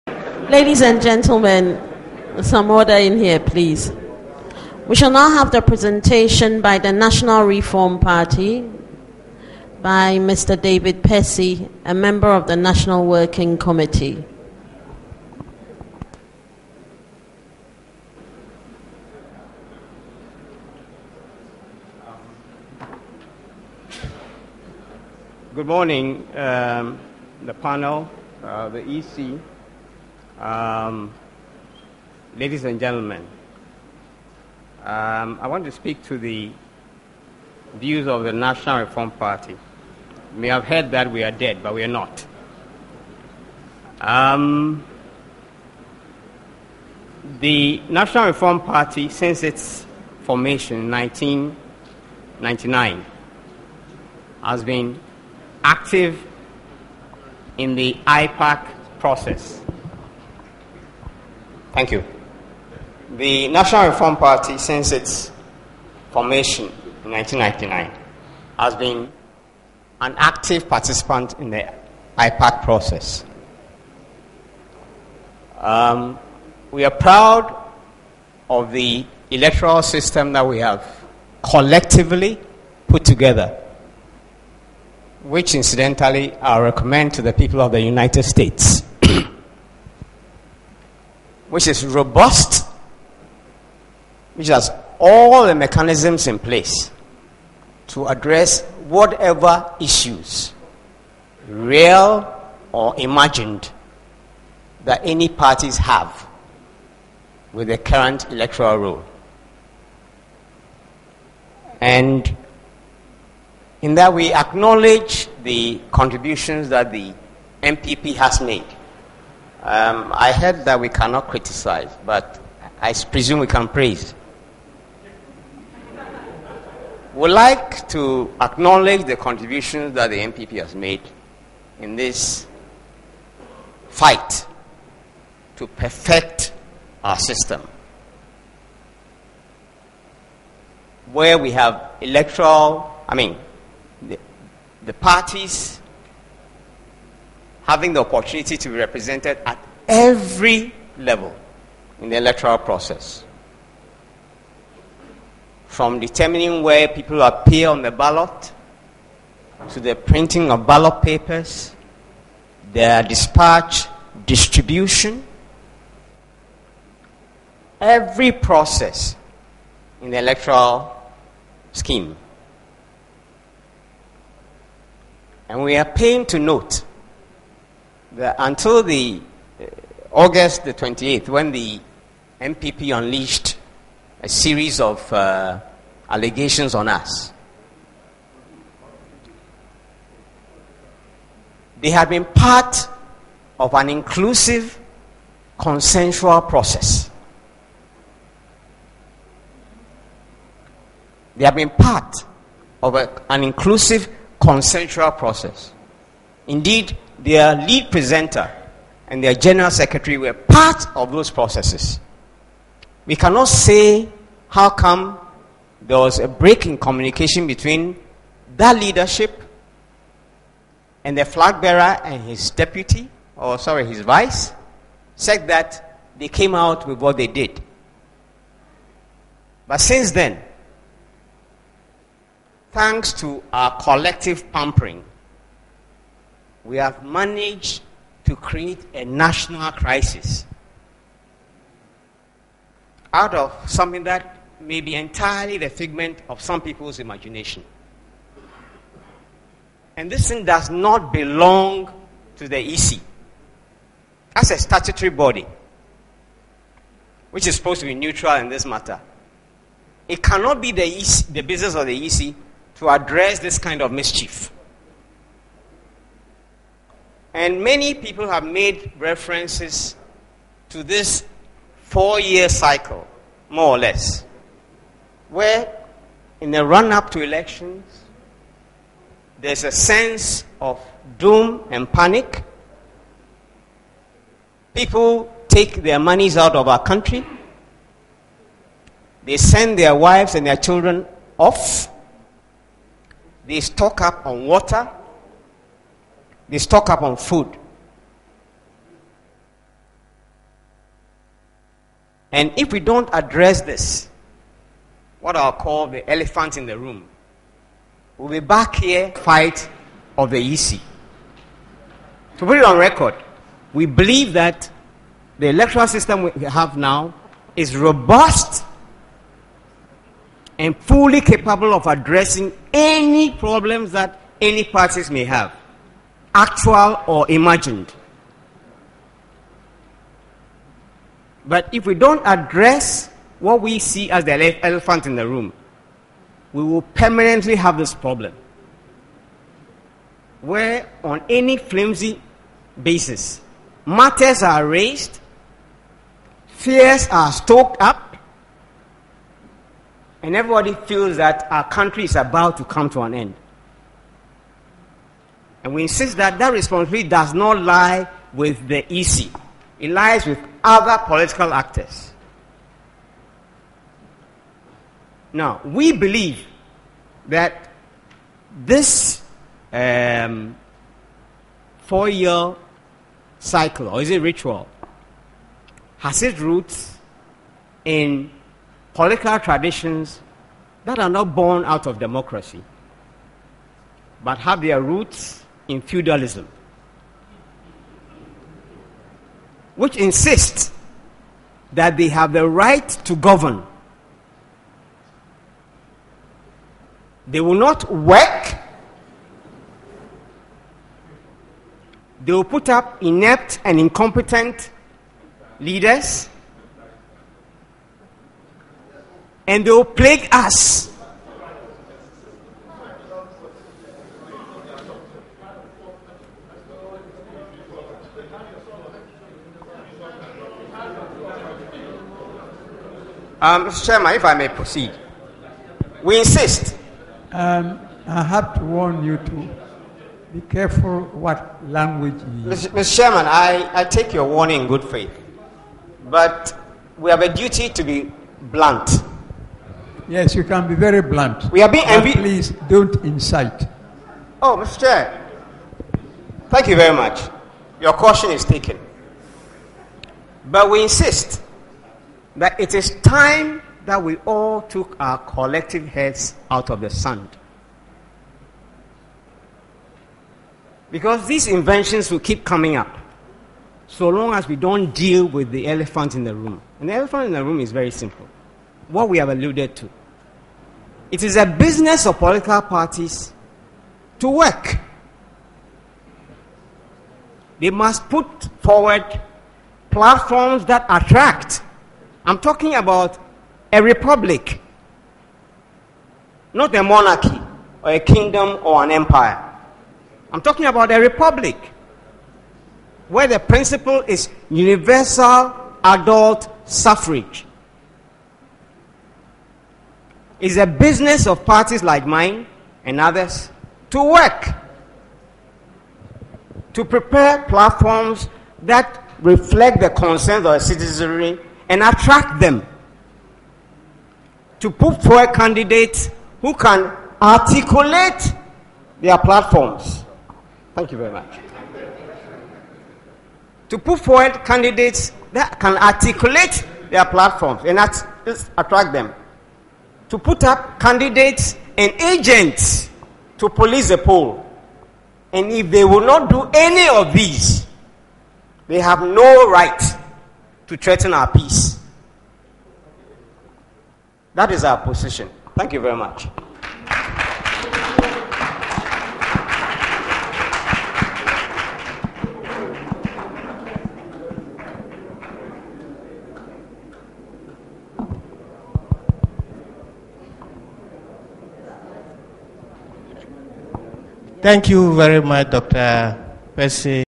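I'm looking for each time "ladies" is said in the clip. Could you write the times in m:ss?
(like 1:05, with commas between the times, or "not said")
0:00, 0:32.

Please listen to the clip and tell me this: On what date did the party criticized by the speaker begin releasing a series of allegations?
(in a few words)
August 28.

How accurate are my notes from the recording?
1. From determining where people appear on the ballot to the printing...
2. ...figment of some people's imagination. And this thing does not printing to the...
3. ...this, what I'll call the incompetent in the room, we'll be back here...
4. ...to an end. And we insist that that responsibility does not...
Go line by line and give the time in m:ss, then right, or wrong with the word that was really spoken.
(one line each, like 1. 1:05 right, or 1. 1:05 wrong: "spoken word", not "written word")
1. 2:35 right
2. 4:05 wrong: "belong", not "printing"
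3. 5:03 wrong: "elephant", not "incompetent"
4. 5:52 right.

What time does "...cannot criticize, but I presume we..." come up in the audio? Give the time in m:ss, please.
2:00.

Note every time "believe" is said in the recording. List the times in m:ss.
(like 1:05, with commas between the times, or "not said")
5:13, 6:05.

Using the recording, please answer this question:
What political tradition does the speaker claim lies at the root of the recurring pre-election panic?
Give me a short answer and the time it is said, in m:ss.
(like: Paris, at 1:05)
Feudalism, at 6:25.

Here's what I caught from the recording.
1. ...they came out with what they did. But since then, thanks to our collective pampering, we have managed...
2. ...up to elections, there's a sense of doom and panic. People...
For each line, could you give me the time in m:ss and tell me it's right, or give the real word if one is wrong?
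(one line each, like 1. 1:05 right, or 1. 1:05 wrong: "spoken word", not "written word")
1. 3:46 right
2. 4:36 right.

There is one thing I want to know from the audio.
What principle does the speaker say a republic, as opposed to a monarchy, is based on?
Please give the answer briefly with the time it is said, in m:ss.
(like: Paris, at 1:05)
Universal adult suffrage, at 8:14.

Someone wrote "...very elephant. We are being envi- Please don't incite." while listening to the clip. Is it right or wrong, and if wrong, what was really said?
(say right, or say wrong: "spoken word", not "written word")
wrong: "blunt", not "elephant".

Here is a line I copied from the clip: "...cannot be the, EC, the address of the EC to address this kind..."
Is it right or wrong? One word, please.
wrong.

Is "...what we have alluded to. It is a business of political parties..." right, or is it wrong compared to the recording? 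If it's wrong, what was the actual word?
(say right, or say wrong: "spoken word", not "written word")
right.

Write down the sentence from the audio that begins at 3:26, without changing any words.
Indeed, their lead presenter and their general secretary were part of those processes.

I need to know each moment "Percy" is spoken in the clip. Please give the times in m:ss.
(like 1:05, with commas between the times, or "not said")
0:11, 9:26.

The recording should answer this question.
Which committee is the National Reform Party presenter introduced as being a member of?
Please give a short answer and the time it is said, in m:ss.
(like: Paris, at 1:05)
National Working Committee, at 0:12.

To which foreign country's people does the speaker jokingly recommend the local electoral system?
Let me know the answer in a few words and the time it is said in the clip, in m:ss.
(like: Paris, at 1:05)
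United States, at 1:27.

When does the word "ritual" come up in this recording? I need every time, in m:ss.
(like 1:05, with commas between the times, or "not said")
6:14.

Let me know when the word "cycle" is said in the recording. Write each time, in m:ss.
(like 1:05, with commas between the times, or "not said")
4:32, 6:13.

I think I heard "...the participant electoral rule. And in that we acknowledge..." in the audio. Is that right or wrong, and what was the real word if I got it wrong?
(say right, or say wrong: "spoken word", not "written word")
wrong: "current", not "participant".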